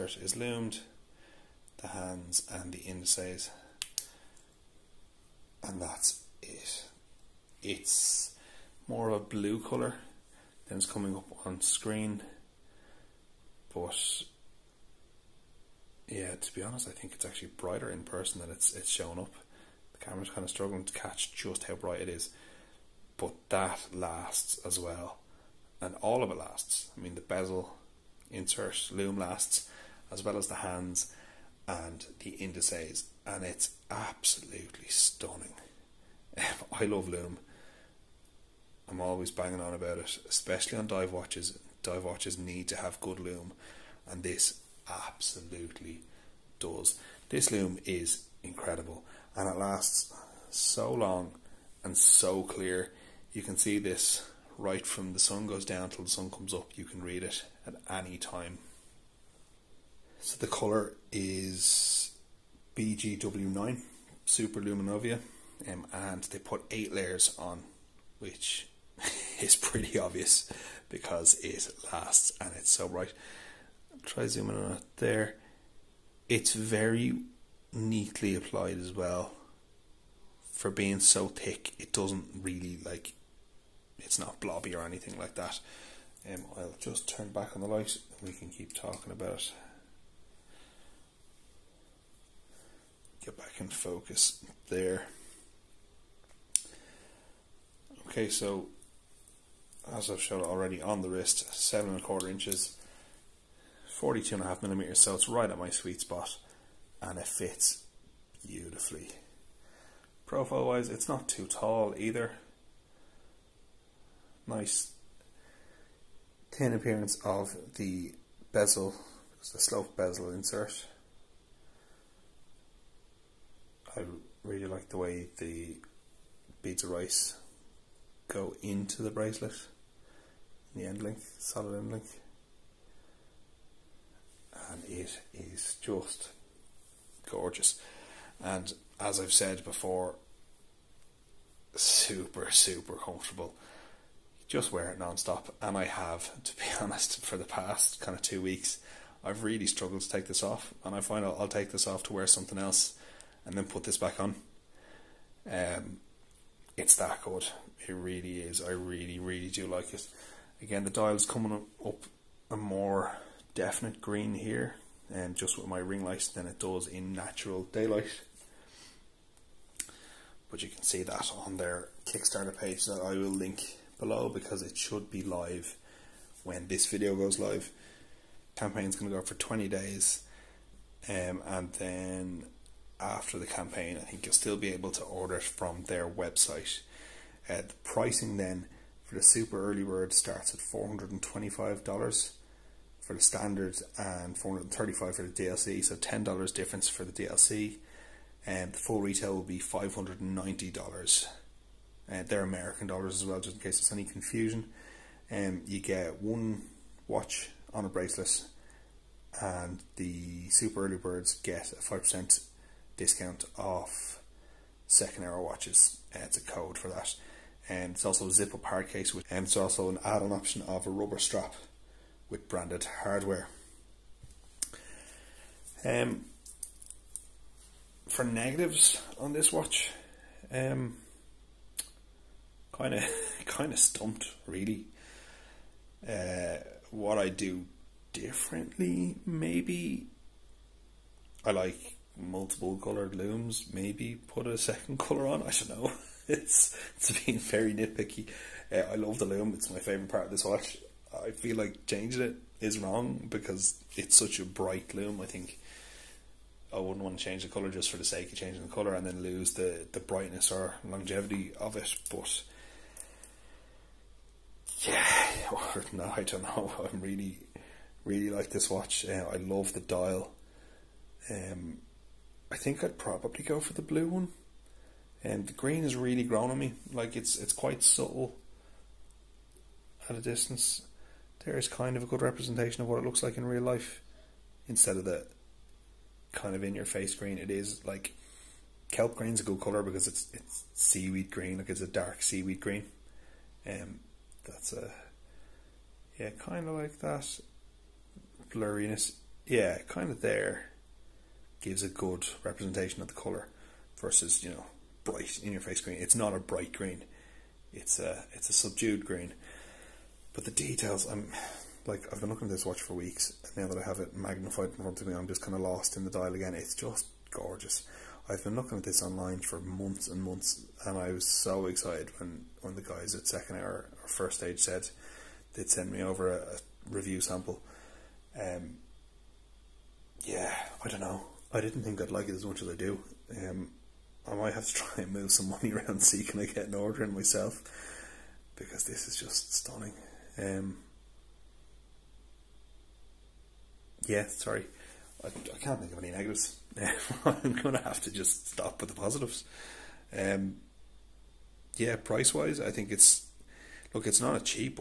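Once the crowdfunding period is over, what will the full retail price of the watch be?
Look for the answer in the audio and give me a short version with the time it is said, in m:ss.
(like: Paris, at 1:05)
$590, at 3:19.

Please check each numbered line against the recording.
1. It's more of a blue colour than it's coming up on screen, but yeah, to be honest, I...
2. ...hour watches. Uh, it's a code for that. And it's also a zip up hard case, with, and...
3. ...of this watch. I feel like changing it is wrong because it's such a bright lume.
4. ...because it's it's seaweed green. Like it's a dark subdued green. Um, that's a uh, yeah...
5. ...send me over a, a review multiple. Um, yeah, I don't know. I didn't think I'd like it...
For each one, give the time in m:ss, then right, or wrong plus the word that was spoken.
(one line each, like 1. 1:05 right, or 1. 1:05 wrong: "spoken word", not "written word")
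1. 0:07 right
2. 3:35 right
3. 4:10 right
4. 4:49 wrong: "seaweed", not "subdued"
5. 5:25 wrong: "sample", not "multiple".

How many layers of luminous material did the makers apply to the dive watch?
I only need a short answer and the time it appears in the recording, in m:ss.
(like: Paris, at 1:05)
8, at 1:06.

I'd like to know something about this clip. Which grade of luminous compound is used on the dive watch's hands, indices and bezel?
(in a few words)
BGW9 Super Luminova.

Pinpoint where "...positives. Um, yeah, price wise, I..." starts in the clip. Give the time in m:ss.
5:48.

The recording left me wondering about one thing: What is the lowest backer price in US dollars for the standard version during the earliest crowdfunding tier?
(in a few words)
$425.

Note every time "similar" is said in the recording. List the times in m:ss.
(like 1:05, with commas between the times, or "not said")
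not said.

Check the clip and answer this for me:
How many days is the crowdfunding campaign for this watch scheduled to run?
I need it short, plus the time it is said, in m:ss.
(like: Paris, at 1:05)
20, at 2:59.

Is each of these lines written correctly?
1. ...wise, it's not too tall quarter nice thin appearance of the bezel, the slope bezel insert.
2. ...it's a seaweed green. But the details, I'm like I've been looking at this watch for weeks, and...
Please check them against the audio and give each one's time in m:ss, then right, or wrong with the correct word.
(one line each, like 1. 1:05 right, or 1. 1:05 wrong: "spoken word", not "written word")
1. 1:50 wrong: "either", not "quarter"
2. 5:08 wrong: "subdued", not "seaweed".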